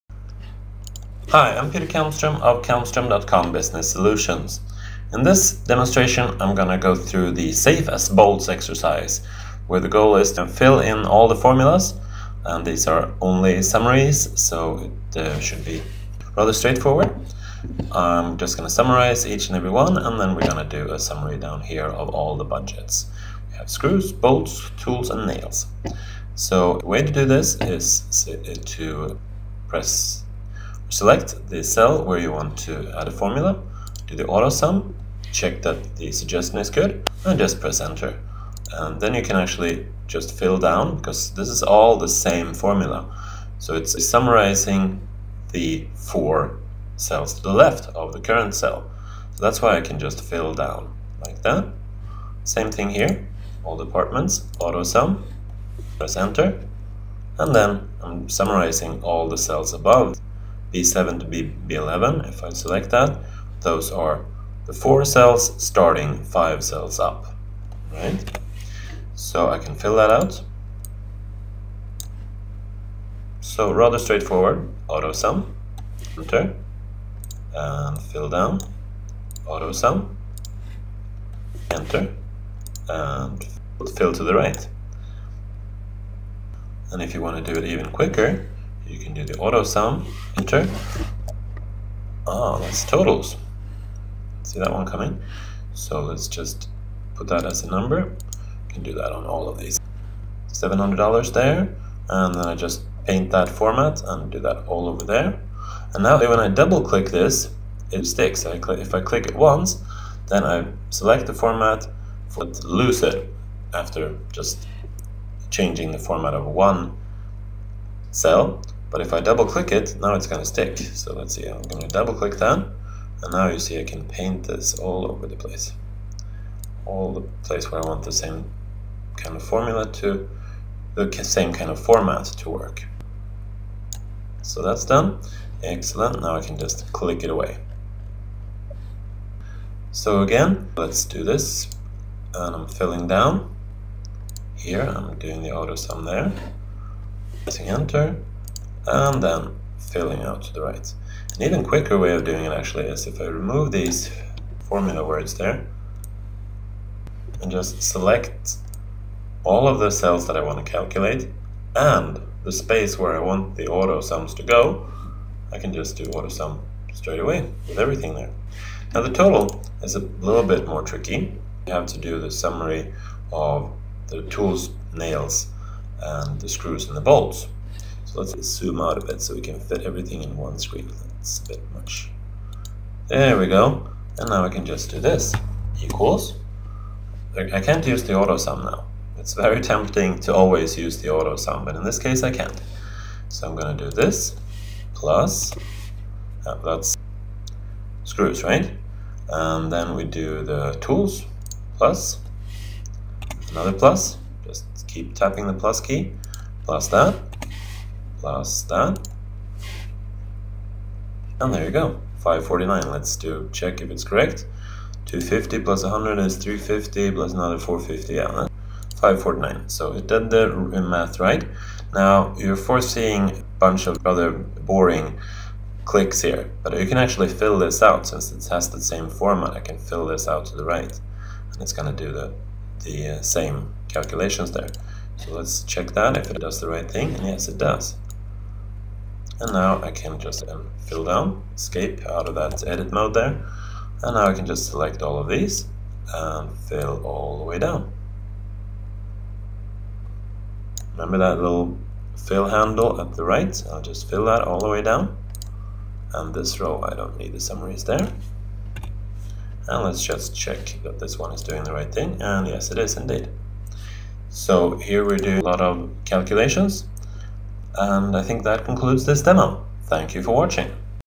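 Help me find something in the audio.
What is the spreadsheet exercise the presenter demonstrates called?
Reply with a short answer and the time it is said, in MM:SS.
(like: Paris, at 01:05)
Safe as Bolts, at 00:07.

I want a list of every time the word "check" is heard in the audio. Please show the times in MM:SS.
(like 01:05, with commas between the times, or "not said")
00:35, 03:33, 03:55, 04:20.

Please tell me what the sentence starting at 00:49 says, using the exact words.
So that's why I can just fill down like that.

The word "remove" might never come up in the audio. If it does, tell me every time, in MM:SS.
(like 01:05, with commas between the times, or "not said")
02:33.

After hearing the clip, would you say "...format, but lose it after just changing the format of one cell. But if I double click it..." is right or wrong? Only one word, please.
right.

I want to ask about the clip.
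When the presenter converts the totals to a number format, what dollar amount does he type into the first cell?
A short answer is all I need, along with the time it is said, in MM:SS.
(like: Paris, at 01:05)
$700, at 01:40.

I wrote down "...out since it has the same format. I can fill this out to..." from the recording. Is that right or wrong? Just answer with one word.
right.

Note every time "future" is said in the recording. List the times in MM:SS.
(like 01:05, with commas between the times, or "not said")
not said.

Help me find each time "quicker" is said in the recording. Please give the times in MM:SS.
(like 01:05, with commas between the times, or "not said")
01:27, 02:31.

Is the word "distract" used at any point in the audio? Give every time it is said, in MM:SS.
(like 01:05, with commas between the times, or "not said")
not said.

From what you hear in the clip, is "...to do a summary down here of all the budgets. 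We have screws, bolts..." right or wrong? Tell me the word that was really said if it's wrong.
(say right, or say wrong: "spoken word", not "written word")
right.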